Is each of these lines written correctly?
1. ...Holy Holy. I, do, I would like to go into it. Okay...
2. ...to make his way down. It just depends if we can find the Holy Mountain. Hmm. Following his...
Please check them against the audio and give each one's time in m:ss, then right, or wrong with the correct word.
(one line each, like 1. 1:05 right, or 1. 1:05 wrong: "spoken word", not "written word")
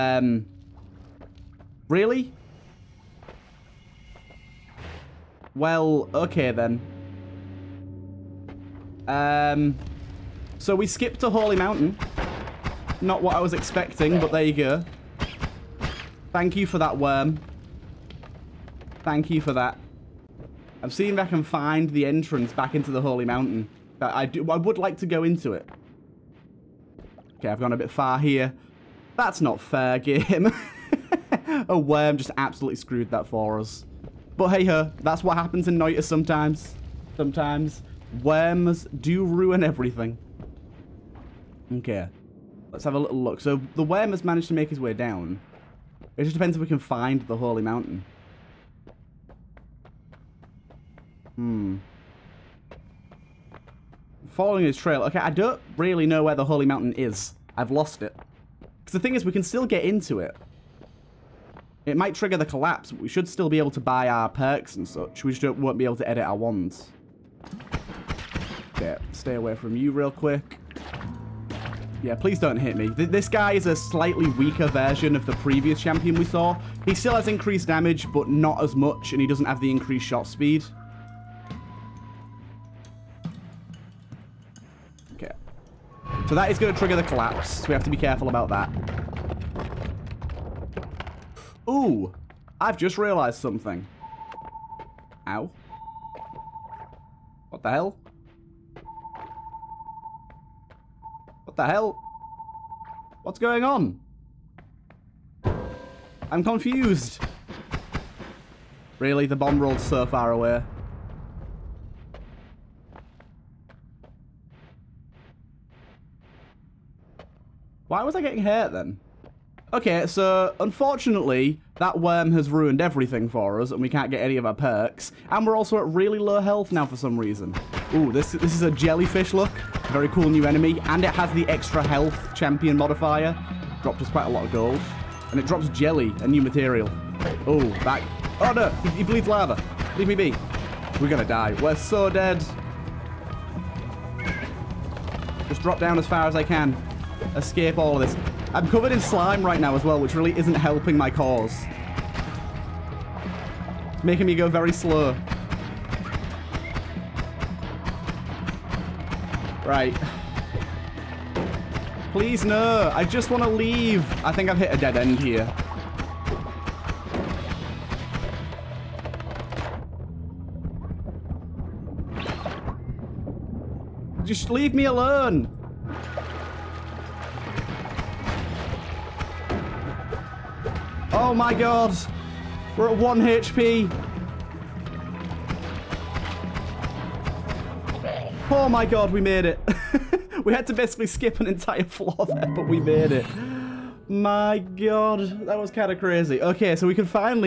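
1. 0:23 wrong: "Mountain", not "Holy"
2. 0:44 right.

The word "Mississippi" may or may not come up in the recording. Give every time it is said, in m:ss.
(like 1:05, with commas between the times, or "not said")
not said.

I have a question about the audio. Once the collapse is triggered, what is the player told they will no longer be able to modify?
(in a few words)
wands.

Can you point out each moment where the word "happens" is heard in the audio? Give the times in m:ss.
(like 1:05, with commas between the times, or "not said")
0:35.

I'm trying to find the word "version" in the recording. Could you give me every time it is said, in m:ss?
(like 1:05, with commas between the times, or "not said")
1:14.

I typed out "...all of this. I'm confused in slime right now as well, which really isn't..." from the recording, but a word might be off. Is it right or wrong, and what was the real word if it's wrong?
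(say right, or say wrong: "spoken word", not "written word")
wrong: "covered", not "confused".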